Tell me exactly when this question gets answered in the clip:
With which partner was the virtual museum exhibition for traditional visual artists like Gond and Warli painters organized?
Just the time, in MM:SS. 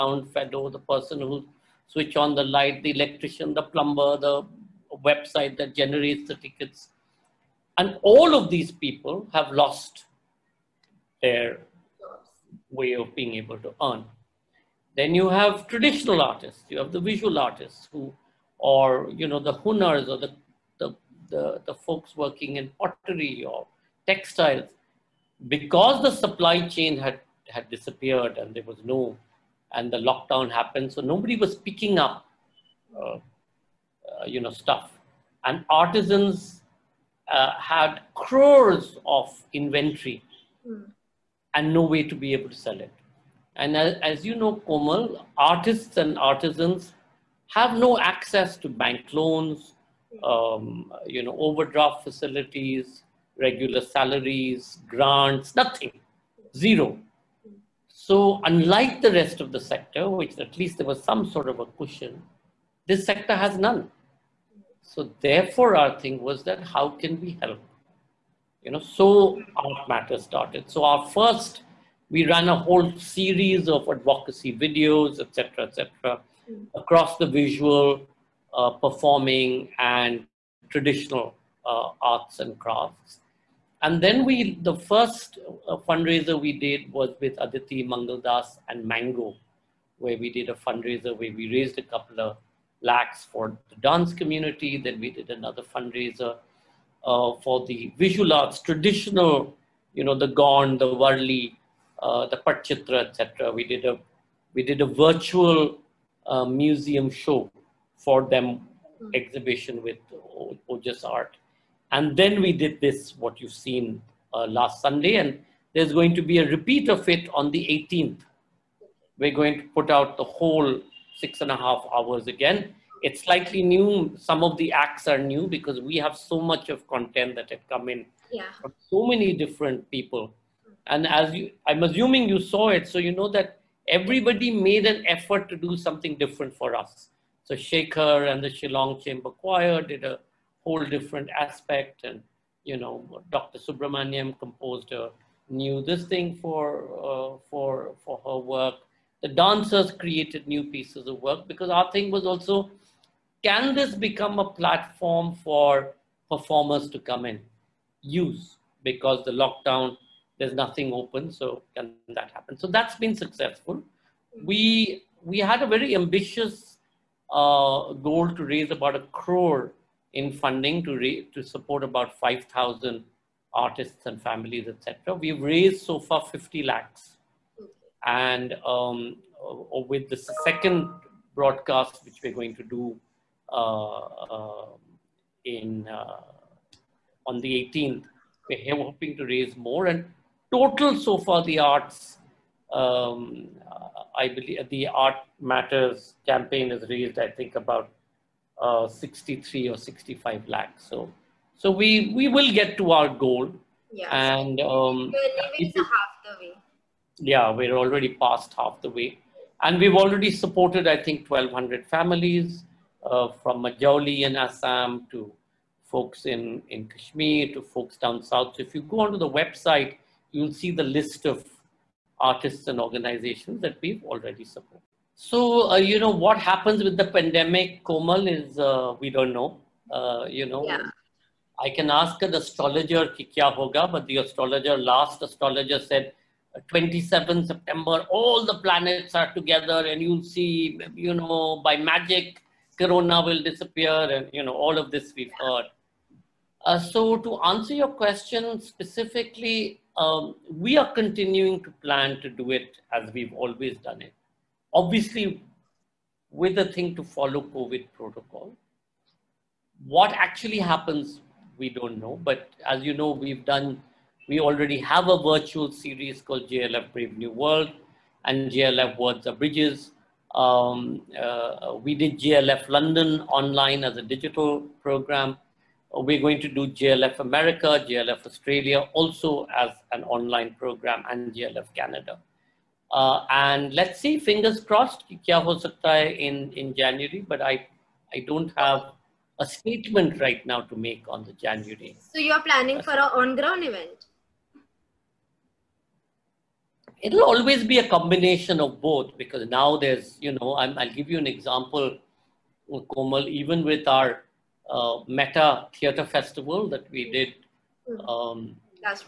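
01:50.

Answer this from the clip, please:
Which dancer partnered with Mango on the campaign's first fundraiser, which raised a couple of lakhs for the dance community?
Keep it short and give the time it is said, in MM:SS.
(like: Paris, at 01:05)
Aditi Mangaldas, at 01:27.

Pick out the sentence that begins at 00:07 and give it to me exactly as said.
And all of these people have lost their way of being able to earn.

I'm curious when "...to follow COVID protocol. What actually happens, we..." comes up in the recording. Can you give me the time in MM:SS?
04:16.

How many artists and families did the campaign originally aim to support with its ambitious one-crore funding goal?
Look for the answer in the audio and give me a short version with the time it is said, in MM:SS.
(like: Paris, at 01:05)
5,000, at 02:52.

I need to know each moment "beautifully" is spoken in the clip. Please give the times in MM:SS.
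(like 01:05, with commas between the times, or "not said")
not said.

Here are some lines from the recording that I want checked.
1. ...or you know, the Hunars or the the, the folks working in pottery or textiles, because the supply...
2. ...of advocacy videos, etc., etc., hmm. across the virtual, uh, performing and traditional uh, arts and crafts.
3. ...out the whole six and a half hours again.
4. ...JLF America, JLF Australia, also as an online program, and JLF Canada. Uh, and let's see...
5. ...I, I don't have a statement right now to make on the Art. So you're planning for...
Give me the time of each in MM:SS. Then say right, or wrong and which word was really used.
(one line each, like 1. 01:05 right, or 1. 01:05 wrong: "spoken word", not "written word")
1. 00:18 right
2. 01:13 wrong: "visual", not "virtual"
3. 01:59 right
4. 04:36 right
5. 04:47 wrong: "January", not "Art".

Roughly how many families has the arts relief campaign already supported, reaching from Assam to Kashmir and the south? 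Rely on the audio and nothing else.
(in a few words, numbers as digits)
1,200.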